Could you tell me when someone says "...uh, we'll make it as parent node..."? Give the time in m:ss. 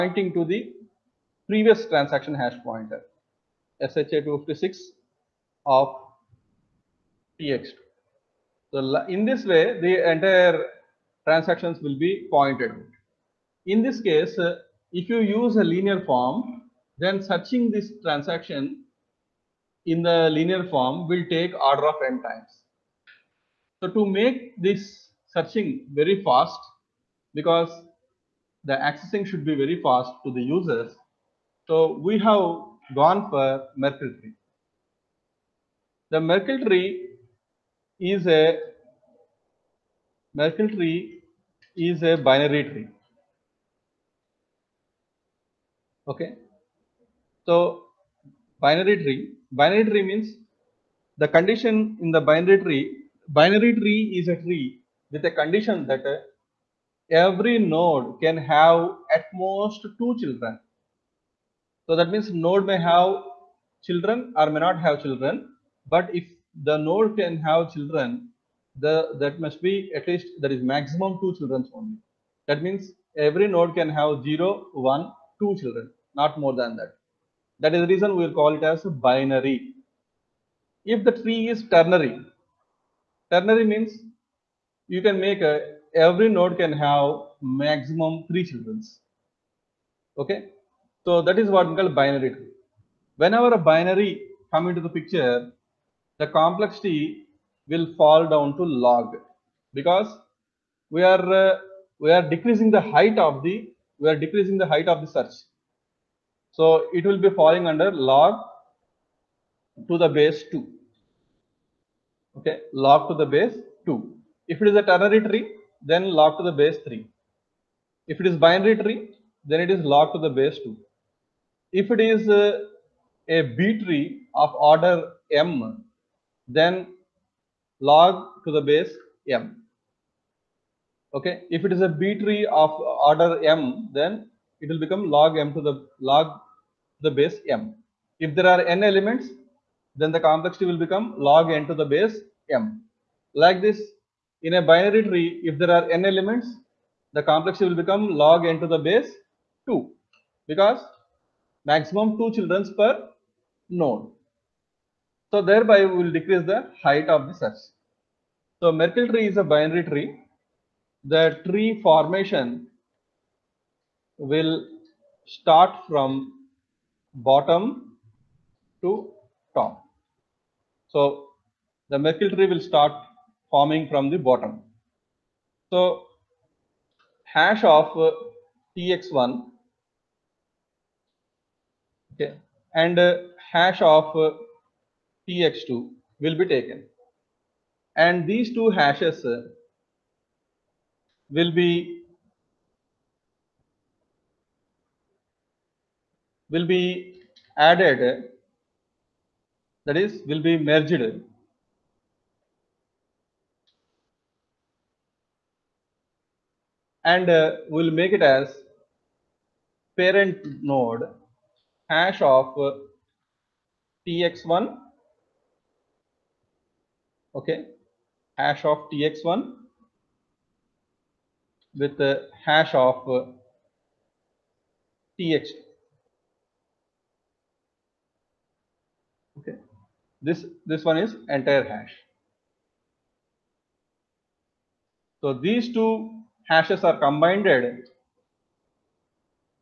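3:27.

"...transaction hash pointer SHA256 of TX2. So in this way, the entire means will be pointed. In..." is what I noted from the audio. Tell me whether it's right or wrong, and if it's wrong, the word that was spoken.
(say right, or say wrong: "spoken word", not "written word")
wrong: "transactions", not "means".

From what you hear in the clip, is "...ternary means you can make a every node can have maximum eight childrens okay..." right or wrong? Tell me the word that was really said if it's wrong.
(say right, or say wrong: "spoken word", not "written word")
wrong: "three", not "eight".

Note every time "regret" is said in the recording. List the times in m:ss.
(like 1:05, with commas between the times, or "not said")
not said.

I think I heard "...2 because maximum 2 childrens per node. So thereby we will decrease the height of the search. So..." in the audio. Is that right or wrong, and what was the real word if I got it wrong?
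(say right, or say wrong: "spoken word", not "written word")
right.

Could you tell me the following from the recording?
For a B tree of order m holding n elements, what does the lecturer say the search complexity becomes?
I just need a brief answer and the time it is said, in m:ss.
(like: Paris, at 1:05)
log n to the base m, at 2:21.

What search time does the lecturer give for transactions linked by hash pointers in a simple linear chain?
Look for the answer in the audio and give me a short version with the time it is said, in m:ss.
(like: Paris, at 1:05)
order of n, at 0:21.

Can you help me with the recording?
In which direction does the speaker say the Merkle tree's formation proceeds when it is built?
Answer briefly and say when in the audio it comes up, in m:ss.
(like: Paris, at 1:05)
bottom to top, at 2:47.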